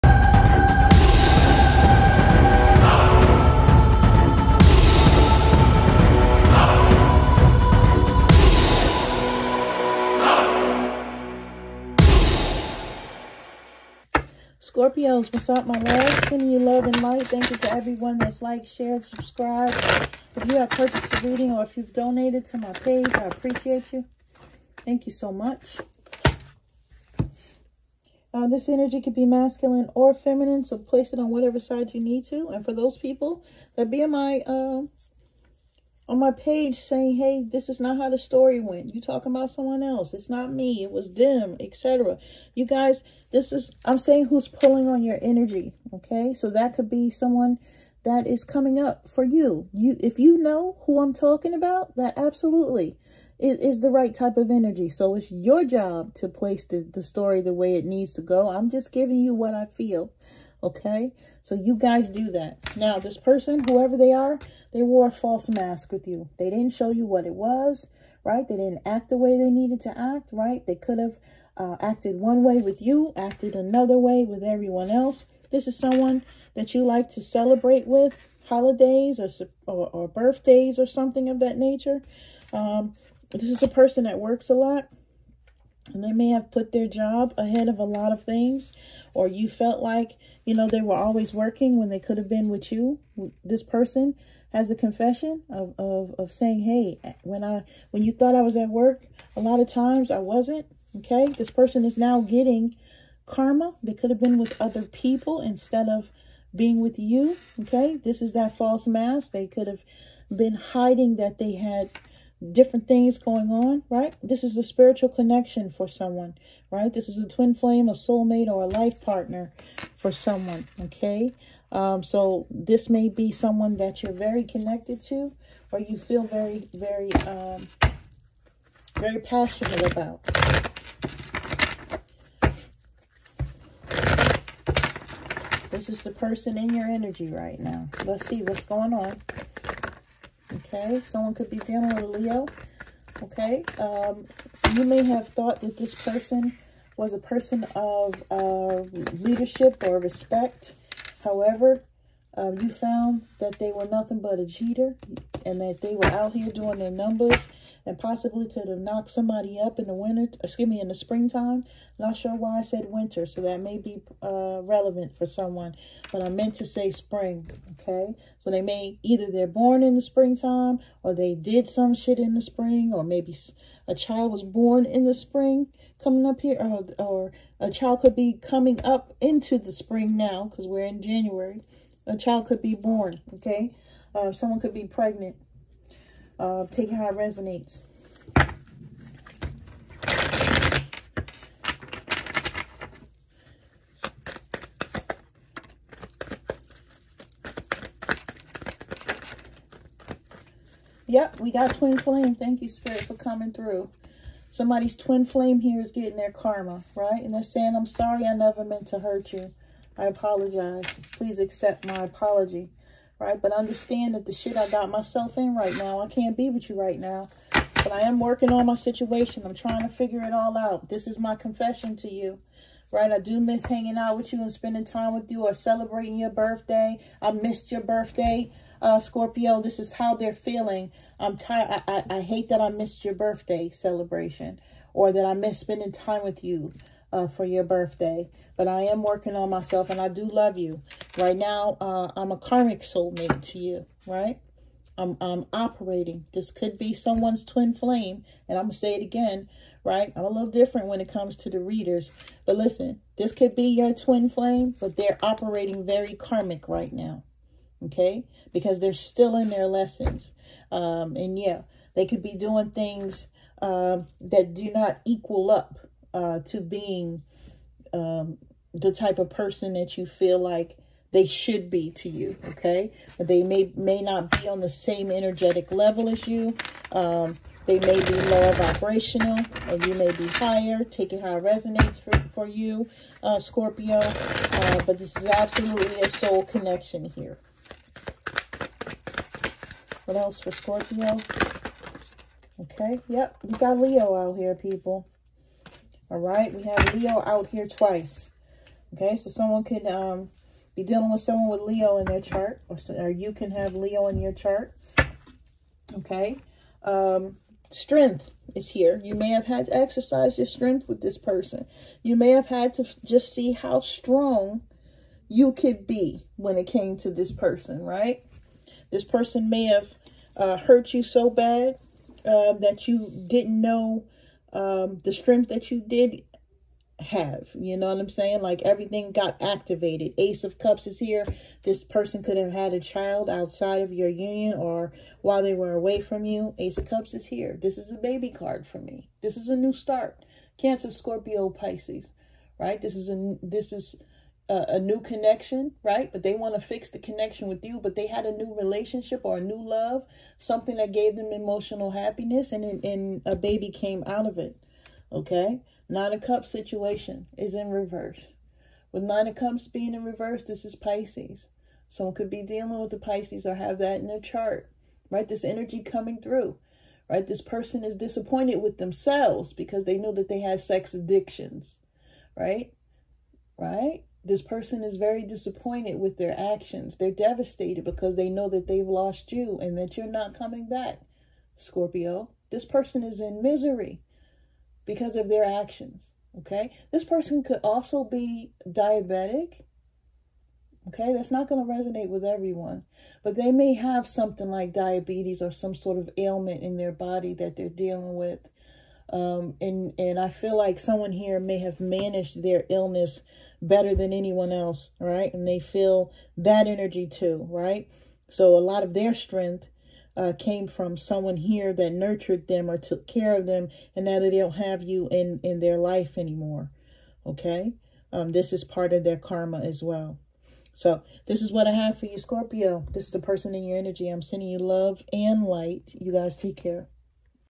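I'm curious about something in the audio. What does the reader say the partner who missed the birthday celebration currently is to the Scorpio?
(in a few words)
A karmic soulmate.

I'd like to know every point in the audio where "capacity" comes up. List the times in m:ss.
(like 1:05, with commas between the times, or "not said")
not said.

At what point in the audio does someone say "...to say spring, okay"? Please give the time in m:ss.
2:46.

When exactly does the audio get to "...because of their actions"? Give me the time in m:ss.
6:24.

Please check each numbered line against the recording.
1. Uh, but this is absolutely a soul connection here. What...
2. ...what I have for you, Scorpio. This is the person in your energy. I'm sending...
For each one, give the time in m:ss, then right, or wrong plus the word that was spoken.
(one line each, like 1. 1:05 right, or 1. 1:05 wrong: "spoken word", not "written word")
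1. 4:43 right
2. 7:01 right.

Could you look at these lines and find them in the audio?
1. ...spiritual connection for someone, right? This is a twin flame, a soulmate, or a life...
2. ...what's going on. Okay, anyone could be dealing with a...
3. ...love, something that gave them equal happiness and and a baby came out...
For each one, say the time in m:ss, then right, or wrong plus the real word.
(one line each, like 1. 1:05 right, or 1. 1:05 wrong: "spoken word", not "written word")
1. 1:54 right
2. 2:18 wrong: "someone", not "anyone"
3. 5:49 wrong: "emotional", not "equal".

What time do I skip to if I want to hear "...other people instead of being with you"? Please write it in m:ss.
1:44.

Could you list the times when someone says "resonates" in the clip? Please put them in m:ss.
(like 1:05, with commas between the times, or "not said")
3:07, 4:41, 6:31.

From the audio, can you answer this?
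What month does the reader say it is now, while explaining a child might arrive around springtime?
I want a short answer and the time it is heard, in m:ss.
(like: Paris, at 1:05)
January, at 3:01.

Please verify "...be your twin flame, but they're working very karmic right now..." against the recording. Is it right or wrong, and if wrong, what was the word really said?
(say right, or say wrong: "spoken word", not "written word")
wrong: "operating", not "working".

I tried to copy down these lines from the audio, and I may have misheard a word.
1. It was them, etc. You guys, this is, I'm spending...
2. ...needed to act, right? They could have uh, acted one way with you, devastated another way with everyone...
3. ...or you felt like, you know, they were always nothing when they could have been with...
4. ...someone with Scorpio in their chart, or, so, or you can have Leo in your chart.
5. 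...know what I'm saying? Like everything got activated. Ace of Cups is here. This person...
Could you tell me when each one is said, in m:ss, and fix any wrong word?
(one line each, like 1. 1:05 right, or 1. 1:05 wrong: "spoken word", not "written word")
1. 0:40 wrong: "saying", not "spending"
2. 1:09 wrong: "acted", not "devastated"
3. 1:29 wrong: "working", not "nothing"
4. 5:01 wrong: "Leo", not "Scorpio"
5. 5:27 right.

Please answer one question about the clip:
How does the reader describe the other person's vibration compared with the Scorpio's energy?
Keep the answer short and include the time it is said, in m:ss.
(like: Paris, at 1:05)
Lower vibrational, at 4:38.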